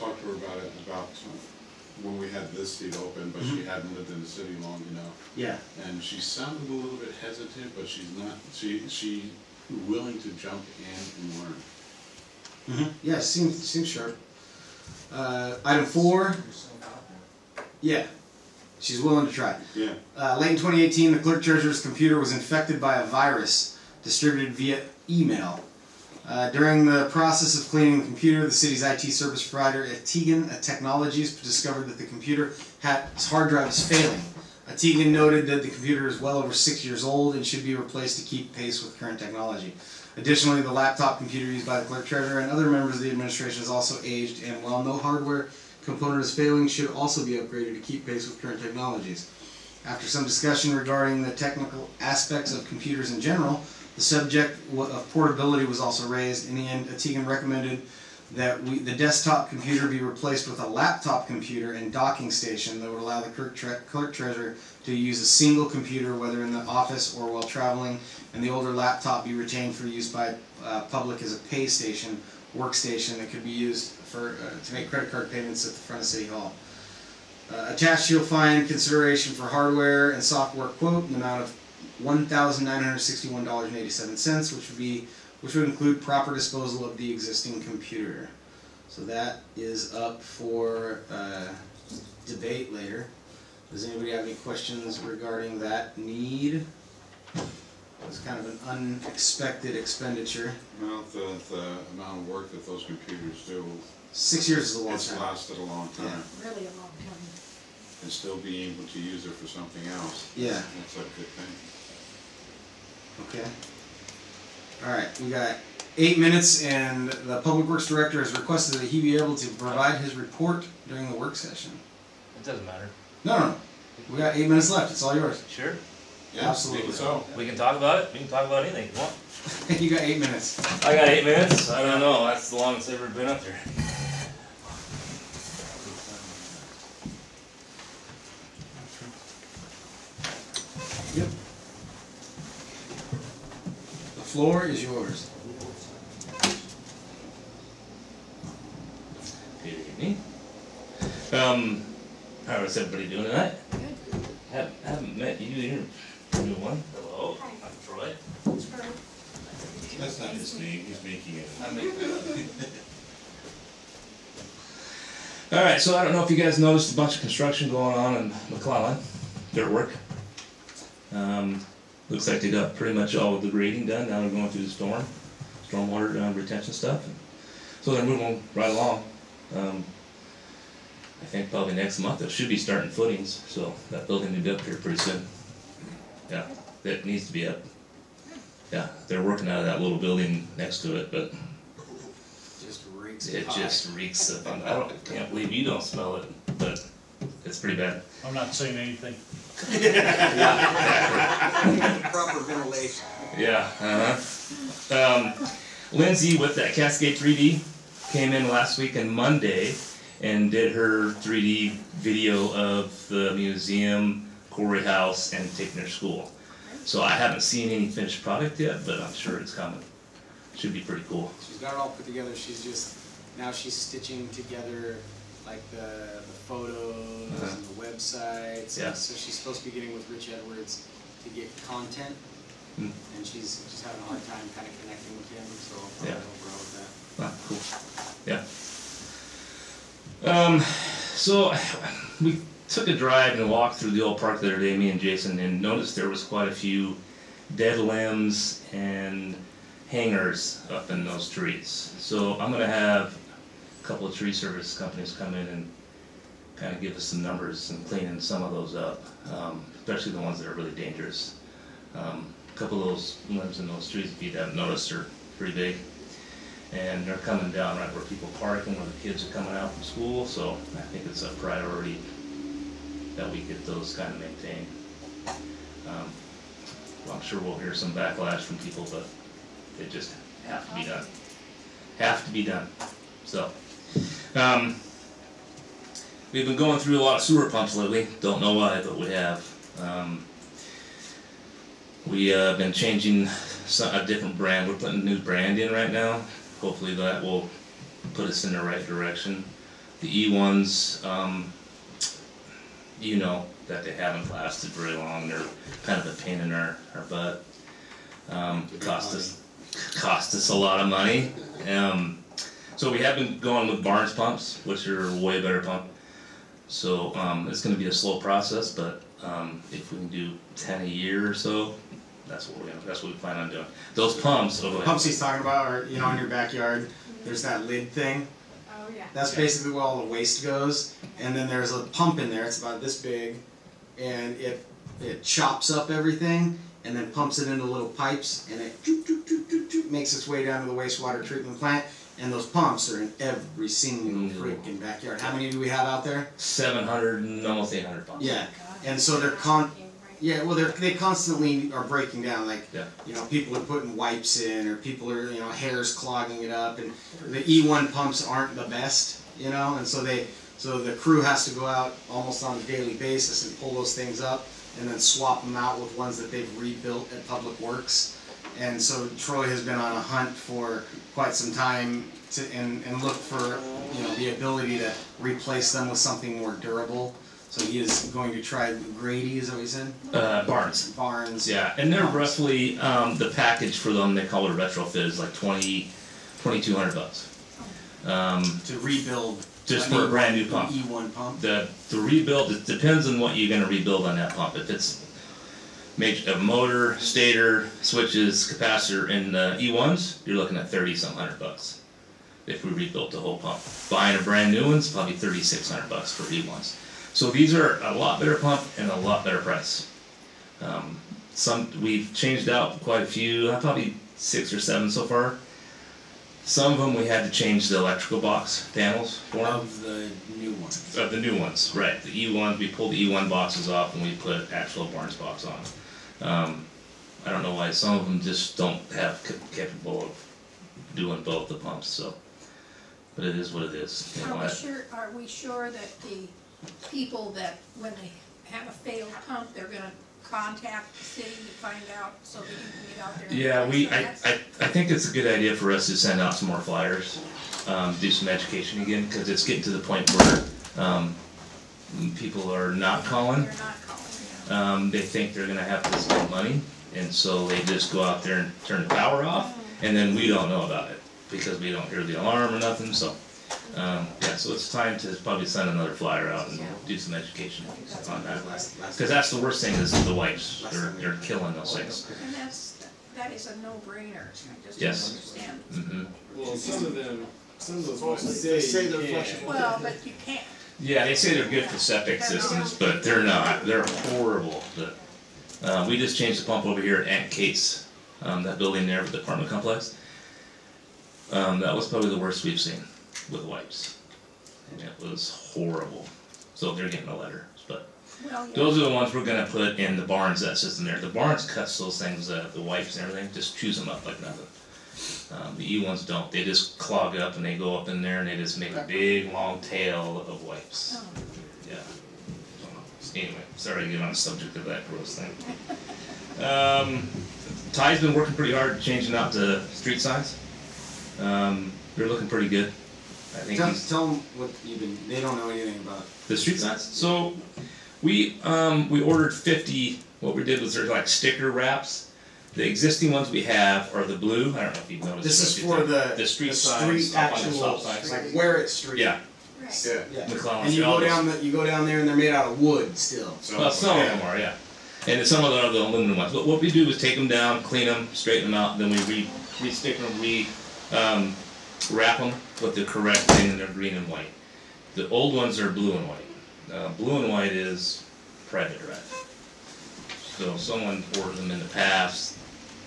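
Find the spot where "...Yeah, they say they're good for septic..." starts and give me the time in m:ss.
8:00.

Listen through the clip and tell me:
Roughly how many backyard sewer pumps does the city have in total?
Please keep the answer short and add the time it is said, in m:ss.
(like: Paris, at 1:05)
almost 800, at 5:47.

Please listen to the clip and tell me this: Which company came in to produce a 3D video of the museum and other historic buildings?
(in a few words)
Cascade 3D.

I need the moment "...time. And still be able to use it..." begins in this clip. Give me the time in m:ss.
1:47.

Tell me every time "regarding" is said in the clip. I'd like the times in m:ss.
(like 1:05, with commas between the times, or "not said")
0:50, 1:35.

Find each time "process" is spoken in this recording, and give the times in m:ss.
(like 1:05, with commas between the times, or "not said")
0:27, 5:18.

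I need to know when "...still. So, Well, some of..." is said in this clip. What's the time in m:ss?
9:02.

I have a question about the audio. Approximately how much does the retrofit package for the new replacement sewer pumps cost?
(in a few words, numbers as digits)
$2,200.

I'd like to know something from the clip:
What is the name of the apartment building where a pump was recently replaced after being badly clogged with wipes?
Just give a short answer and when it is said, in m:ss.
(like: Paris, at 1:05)
Aunt Kate's, at 8:07.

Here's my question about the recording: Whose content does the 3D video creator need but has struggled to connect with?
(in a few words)
Rich Edwards.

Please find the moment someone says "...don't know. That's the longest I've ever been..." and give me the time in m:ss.
2:11.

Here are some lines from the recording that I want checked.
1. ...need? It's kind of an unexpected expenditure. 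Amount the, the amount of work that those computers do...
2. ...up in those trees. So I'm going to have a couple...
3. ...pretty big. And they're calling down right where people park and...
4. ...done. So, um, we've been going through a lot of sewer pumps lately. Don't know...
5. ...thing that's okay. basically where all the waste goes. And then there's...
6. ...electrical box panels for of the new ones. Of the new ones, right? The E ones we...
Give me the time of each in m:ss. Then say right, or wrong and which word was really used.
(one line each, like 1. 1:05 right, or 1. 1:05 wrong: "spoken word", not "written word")
1. 1:35 right
2. 4:10 right
3. 4:25 wrong: "coming", not "calling"
4. 4:42 right
5. 5:27 right
6. 6:57 right.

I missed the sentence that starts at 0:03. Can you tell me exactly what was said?
hadn't lived in the city long enough.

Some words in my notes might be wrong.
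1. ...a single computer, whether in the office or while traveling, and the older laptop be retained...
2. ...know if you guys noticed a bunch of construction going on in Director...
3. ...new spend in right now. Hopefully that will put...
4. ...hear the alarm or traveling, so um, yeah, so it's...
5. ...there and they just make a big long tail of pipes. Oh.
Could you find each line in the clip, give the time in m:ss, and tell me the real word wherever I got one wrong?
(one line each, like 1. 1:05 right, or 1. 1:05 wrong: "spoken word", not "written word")
1. 1:05 right
2. 2:46 wrong: "McClellan", not "Director"
3. 4:55 wrong: "brand", not "spend"
4. 7:41 wrong: "nothing", not "traveling"
5. 8:28 wrong: "wipes", not "pipes".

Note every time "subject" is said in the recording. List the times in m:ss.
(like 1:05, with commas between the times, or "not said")
0:54, 8:34.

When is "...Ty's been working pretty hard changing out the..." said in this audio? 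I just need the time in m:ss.
8:37.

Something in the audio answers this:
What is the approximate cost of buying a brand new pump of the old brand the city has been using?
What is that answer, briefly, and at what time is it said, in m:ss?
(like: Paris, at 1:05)
$3,600, at 6:45.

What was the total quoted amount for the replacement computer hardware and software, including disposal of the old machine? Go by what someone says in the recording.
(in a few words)
$1,961.87.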